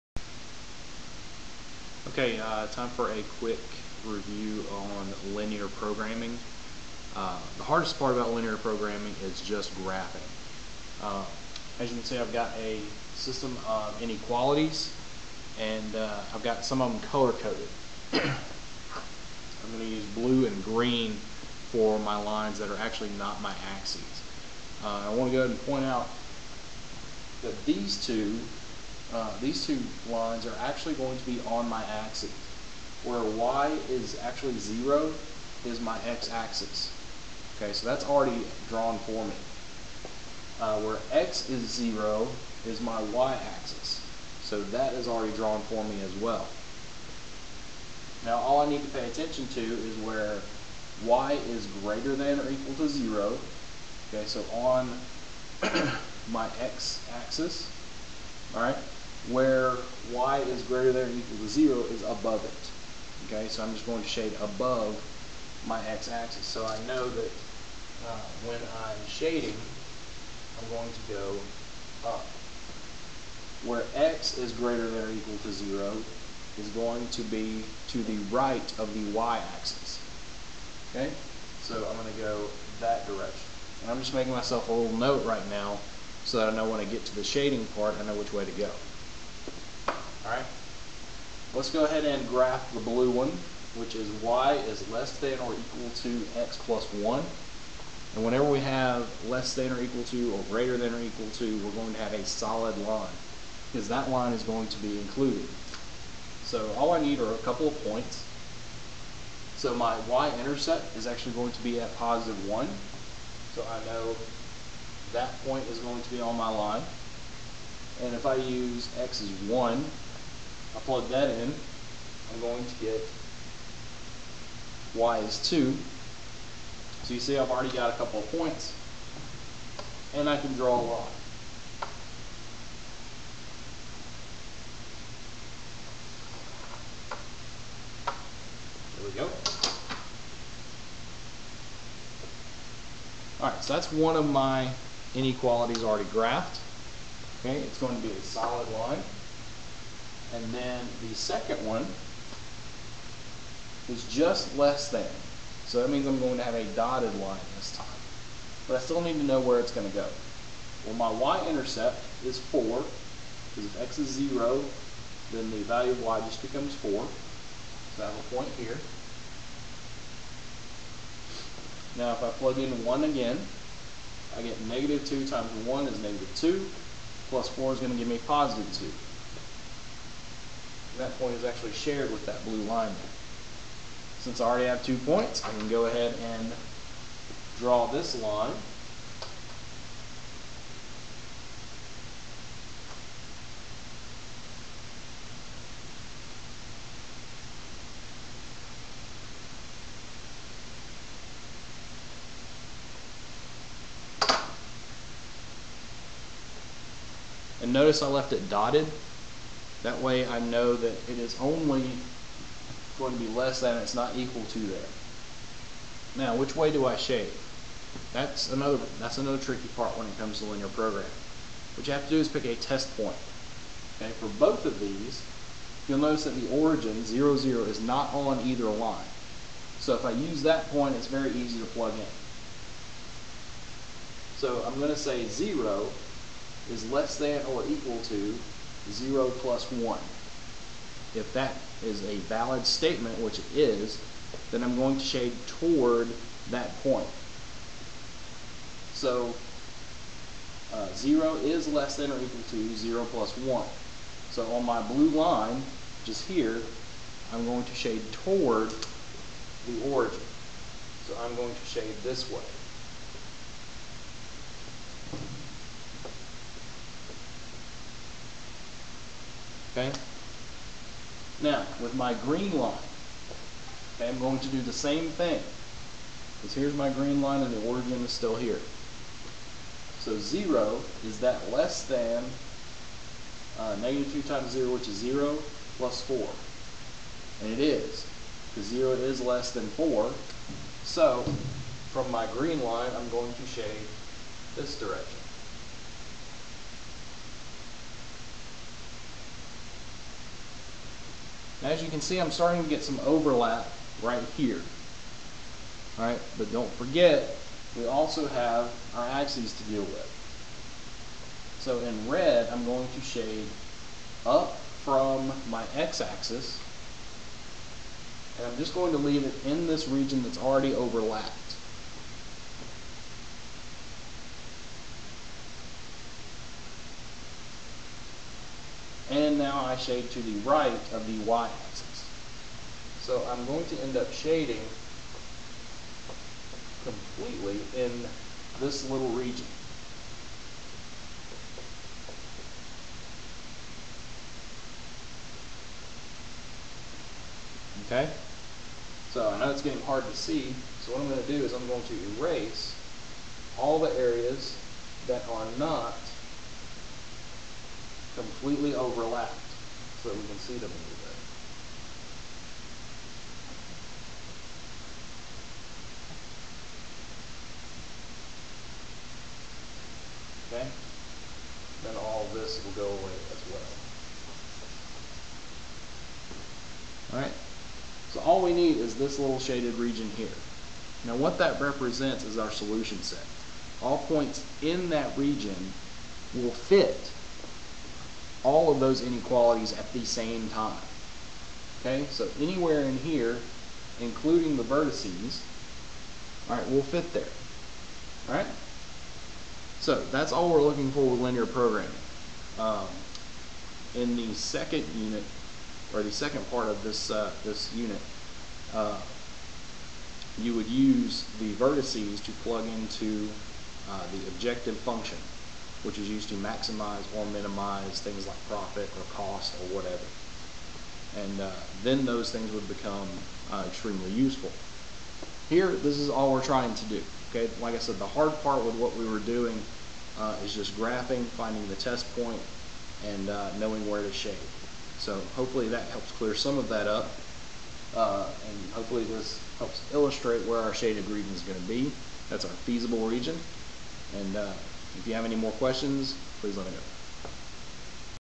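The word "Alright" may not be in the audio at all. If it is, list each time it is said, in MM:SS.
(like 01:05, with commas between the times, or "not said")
01:30, 02:23, 06:17.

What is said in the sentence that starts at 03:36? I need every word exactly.
Now, which way do I shade?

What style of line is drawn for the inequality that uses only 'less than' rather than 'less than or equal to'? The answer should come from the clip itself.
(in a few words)
dotted line.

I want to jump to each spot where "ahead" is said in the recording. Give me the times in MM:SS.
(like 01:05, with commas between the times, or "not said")
00:25, 01:31, 03:05.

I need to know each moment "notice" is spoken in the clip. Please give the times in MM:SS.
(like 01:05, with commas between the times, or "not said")
03:27, 03:45.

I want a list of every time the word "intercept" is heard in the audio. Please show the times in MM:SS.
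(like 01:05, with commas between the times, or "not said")
01:50, 02:41.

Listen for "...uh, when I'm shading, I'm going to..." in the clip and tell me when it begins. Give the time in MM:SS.
01:08.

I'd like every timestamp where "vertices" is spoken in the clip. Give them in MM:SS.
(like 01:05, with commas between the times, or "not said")
06:34, 06:51.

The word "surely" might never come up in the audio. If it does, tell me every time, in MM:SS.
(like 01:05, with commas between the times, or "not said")
not said.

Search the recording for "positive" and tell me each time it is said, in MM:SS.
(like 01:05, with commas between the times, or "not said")
01:51, 02:58.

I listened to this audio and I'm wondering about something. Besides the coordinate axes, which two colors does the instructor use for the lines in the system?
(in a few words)
blue and green.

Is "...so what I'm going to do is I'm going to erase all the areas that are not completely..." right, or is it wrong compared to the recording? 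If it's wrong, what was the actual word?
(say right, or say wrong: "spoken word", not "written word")
right.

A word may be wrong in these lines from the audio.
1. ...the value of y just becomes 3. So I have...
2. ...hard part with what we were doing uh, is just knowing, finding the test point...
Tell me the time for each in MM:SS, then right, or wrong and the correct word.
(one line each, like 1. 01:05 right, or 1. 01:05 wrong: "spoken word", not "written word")
1. 02:45 wrong: "4", not "3"
2. 07:08 wrong: "graphing", not "knowing".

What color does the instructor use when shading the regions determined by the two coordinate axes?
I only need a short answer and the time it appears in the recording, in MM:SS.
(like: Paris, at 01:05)
red, at 05:12.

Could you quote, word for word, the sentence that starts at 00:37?
Okay, so that's already drawn for me.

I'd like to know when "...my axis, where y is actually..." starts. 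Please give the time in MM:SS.
00:31.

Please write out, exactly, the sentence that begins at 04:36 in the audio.
Because here's my green line and the origin is still here.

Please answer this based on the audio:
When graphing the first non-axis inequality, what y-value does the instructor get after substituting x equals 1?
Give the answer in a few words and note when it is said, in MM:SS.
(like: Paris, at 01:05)
2, at 02:04.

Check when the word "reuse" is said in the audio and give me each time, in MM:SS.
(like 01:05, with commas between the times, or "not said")
not said.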